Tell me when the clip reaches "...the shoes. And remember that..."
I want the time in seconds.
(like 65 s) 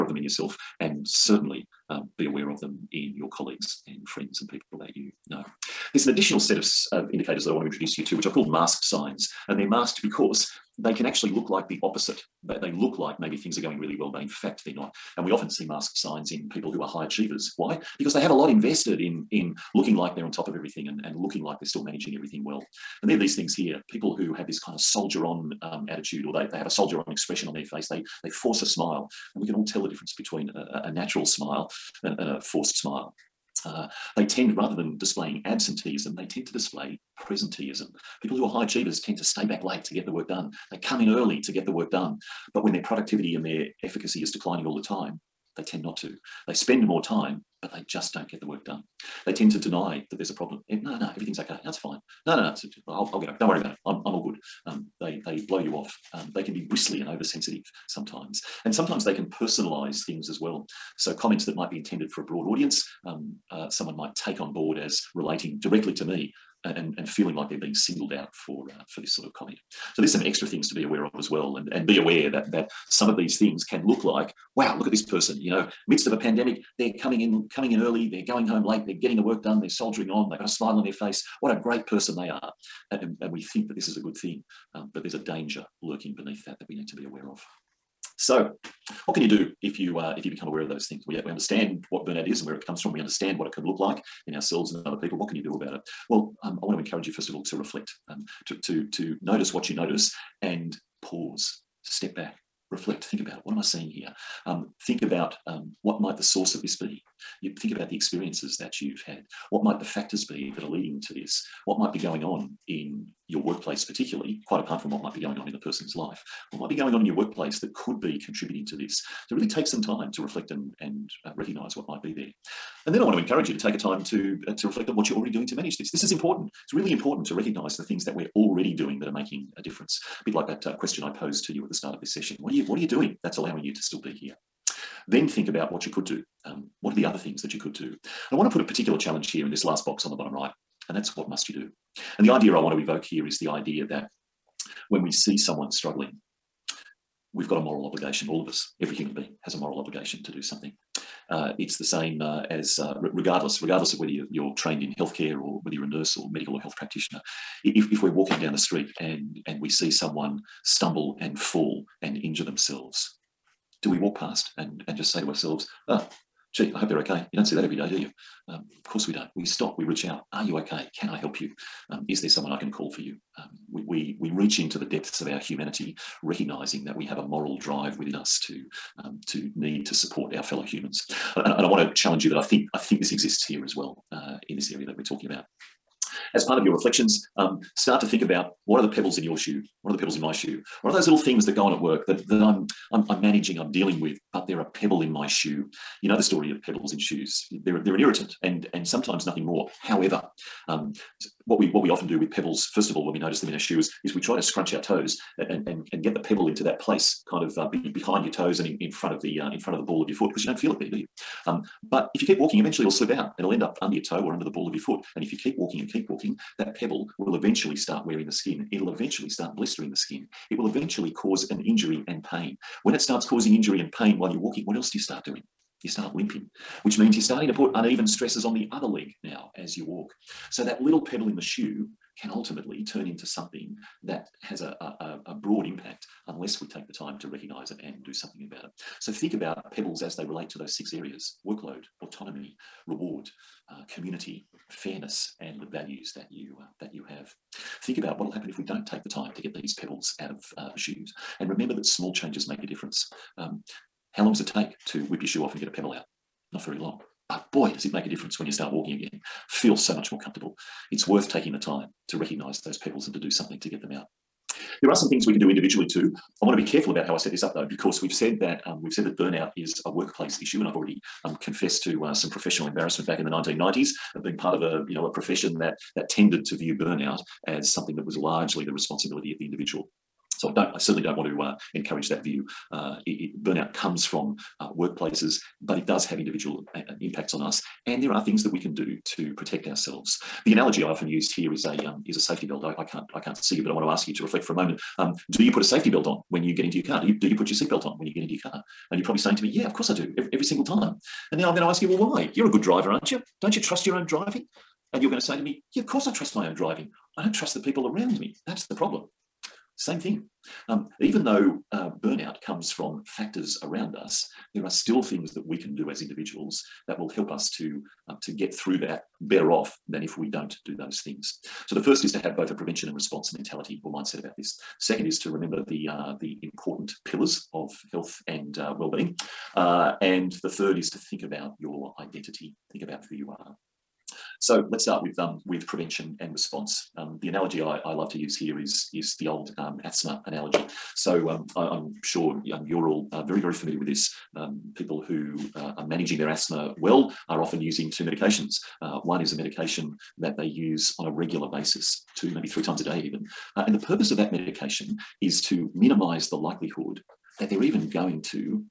250 s.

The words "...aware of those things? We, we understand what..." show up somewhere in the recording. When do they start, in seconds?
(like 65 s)
90 s.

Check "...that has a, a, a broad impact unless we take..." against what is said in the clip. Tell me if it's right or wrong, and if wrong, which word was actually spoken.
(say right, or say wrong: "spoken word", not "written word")
right.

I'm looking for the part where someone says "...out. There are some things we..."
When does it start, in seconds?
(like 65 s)
263 s.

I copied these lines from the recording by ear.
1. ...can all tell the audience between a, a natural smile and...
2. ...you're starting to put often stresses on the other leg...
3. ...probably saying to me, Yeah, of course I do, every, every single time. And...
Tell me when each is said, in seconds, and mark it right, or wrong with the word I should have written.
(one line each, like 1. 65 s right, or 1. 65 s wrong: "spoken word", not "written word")
1. 29 s wrong: "difference", not "audience"
2. 227 s wrong: "uneven", not "often"
3. 299 s right.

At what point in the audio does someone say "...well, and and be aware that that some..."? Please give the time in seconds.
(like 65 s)
71 s.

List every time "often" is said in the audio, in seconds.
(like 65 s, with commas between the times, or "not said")
15 s, 201 s, 290 s, 347 s.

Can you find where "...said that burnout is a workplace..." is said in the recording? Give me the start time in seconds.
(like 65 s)
268 s.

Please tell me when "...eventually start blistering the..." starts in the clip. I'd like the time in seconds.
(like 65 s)
218 s.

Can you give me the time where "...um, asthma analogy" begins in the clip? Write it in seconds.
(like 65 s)
339 s.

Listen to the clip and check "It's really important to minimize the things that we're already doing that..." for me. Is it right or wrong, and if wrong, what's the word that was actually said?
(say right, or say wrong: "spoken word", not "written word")
wrong: "recognize", not "minimize".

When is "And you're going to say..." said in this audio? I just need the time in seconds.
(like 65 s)
304 s.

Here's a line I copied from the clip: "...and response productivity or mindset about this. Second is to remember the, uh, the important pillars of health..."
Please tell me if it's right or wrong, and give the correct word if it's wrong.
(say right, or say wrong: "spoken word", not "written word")
wrong: "mentality", not "productivity".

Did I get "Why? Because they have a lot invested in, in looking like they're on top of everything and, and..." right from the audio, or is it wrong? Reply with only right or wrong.
right.